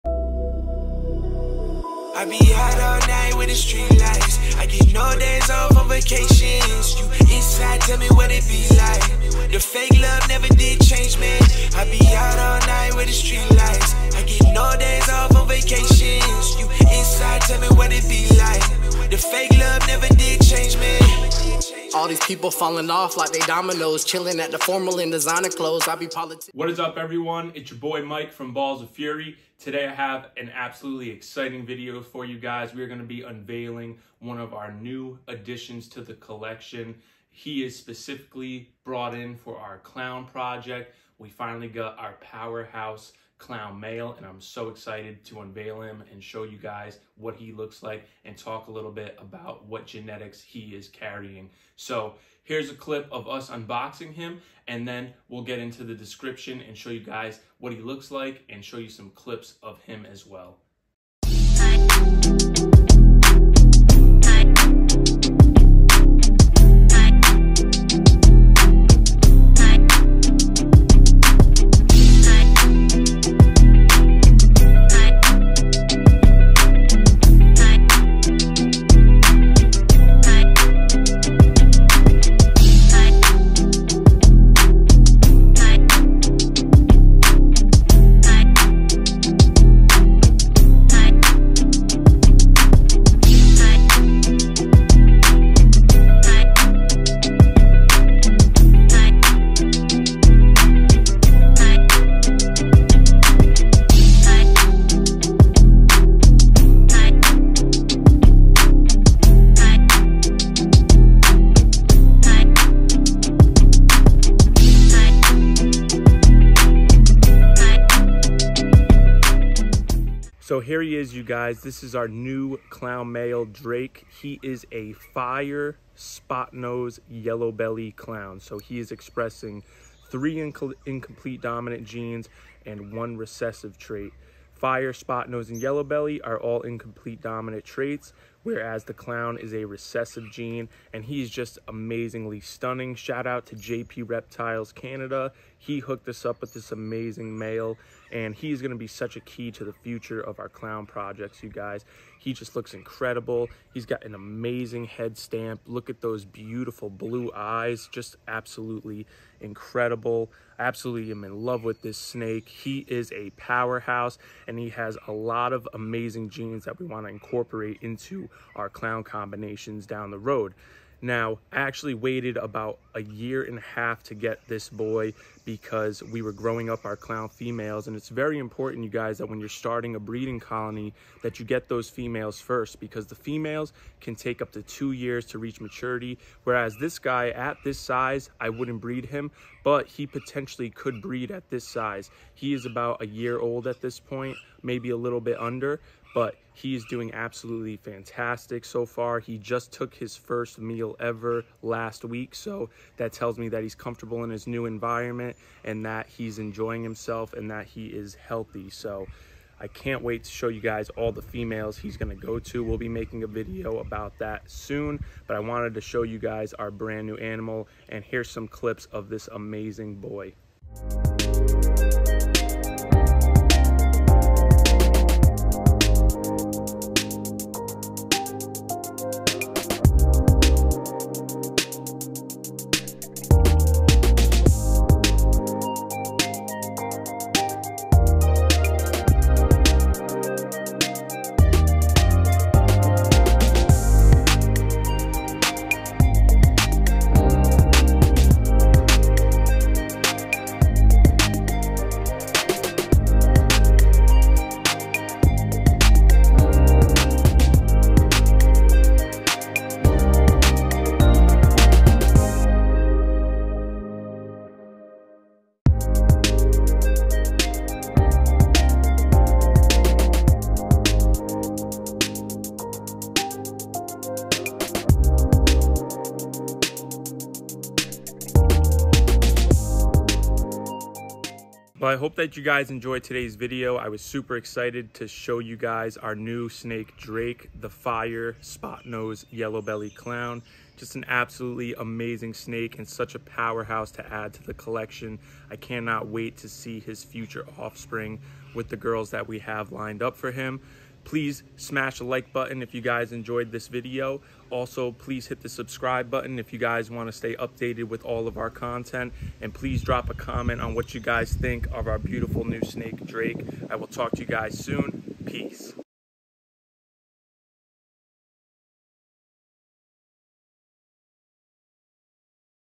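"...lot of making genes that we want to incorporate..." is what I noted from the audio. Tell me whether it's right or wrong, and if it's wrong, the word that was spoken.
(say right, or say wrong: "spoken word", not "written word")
wrong: "amazing", not "making".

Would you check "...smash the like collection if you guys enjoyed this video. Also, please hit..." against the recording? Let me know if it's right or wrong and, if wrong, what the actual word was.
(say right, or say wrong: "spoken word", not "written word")
wrong: "button", not "collection".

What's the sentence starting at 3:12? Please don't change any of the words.
He is about a year old at this point, maybe a little bit under, but he is doing absolutely fantastic so far.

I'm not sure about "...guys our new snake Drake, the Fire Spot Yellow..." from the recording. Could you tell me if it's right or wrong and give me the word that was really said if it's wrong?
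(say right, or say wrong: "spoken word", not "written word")
wrong: "Nose", not "Yellow".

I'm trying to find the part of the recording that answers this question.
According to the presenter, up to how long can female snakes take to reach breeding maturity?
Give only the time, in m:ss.
3:04.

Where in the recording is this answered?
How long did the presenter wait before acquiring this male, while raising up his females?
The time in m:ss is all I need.
2:52.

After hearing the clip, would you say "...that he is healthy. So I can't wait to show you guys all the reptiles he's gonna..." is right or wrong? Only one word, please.
wrong.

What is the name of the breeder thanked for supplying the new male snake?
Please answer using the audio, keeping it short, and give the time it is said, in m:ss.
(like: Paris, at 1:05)
JP Reptiles Canada, at 2:23.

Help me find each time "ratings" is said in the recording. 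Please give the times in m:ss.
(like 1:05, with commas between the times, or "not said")
not said.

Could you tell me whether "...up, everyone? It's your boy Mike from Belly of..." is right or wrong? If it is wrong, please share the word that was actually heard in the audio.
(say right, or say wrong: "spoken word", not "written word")
wrong: "Balls", not "Belly".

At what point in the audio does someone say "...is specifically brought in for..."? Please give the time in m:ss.
0:37.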